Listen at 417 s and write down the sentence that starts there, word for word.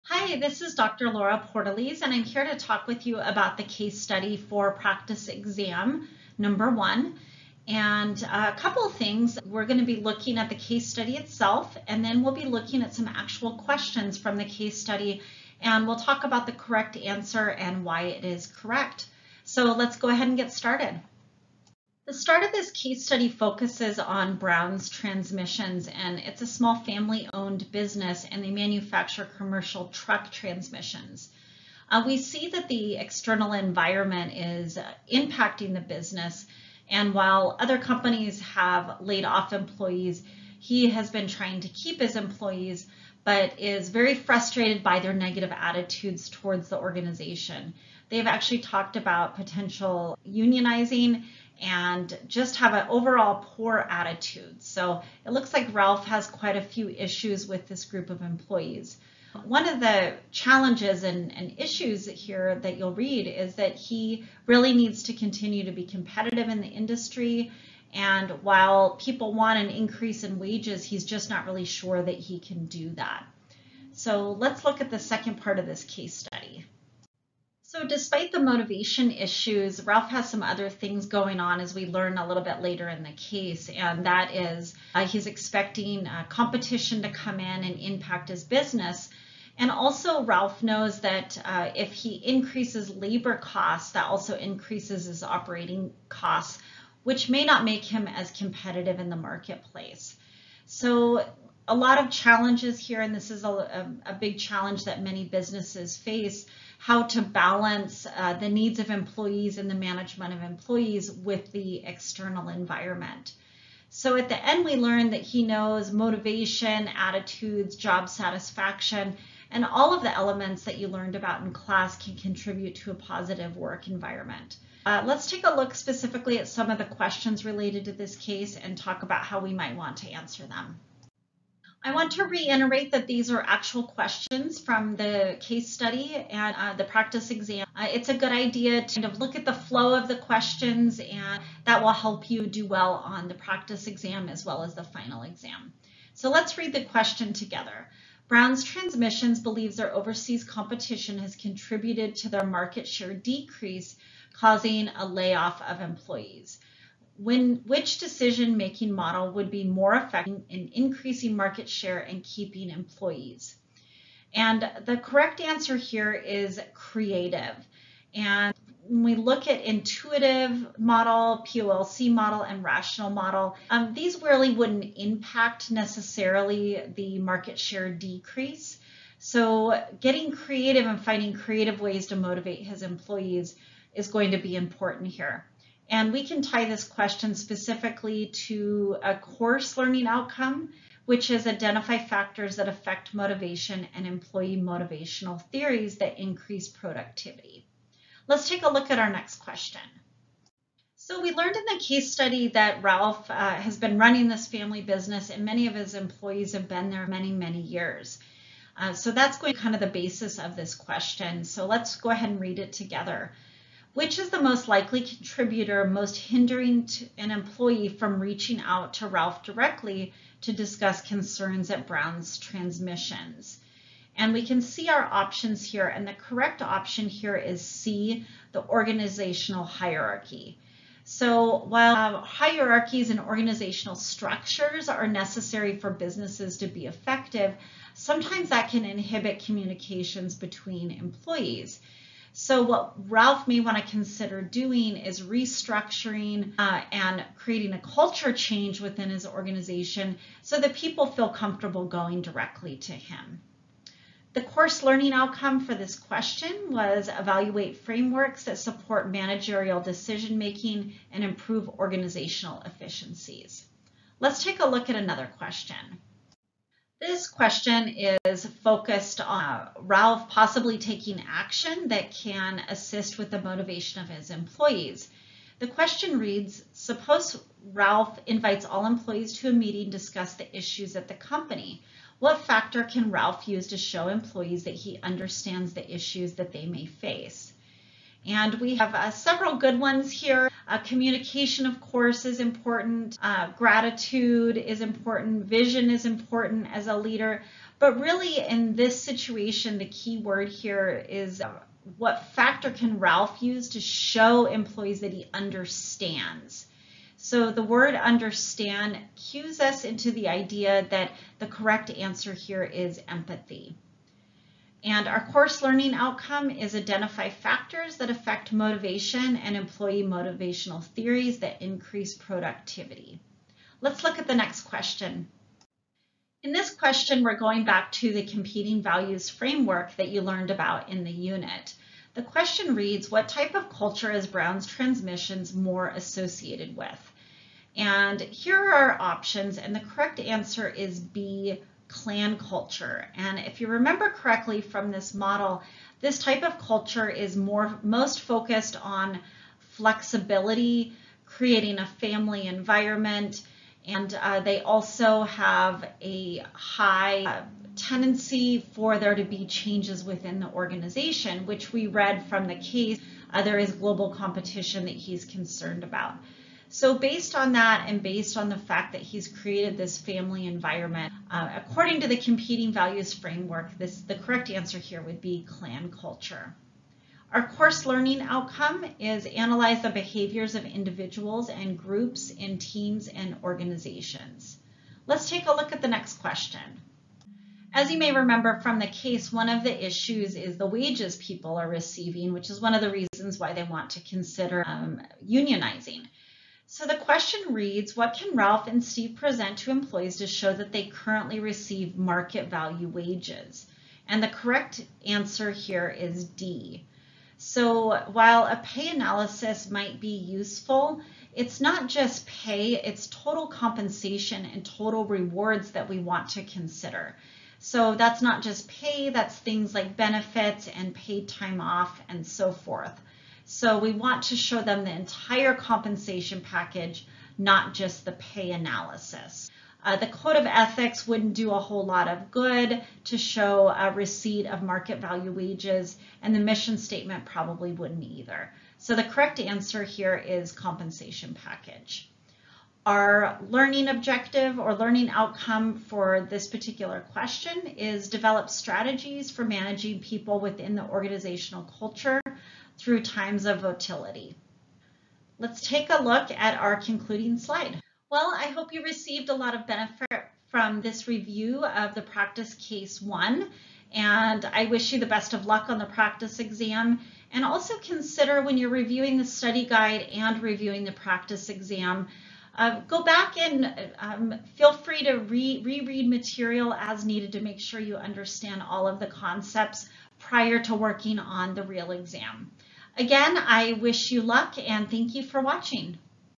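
So that's not just pay, that's things like benefits and paid time off and so forth.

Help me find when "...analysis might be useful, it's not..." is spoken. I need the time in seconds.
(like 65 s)
408 s.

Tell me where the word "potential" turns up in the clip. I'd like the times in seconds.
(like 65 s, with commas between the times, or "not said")
49 s.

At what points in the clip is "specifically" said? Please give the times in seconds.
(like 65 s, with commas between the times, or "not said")
125 s, 187 s.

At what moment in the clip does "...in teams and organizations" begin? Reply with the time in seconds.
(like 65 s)
382 s.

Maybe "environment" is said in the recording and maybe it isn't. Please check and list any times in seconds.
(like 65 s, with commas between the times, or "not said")
33 s, 112 s, 123 s, 352 s, 370 s.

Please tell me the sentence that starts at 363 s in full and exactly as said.
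Uh, there is global competition that he's concerned about.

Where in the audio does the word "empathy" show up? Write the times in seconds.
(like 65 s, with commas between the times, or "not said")
313 s.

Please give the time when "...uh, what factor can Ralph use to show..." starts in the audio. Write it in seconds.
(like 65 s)
301 s.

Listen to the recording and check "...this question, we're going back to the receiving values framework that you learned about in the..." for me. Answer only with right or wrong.
wrong.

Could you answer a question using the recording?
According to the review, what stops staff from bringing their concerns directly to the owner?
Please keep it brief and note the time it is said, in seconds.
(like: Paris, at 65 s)
The organizational hierarchy, at 228 s.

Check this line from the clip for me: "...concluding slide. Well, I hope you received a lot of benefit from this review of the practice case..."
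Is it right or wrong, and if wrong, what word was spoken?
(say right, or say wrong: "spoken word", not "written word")
right.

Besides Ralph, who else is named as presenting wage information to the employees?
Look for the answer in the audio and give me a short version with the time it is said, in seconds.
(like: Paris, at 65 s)
Steve, at 398 s.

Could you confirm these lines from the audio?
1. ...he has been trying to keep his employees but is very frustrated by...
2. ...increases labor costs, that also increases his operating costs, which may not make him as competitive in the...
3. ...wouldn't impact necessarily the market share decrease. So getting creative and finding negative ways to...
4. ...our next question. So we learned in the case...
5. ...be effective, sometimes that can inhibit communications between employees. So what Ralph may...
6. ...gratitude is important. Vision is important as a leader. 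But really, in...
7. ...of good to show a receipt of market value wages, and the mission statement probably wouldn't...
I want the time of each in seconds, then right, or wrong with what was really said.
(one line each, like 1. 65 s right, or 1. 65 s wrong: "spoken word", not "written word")
1. 40 s right
2. 92 s right
3. 174 s wrong: "creative", not "negative"
4. 198 s right
5. 236 s right
6. 293 s right
7. 432 s right.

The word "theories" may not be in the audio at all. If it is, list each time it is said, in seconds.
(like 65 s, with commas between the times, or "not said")
195 s, 320 s.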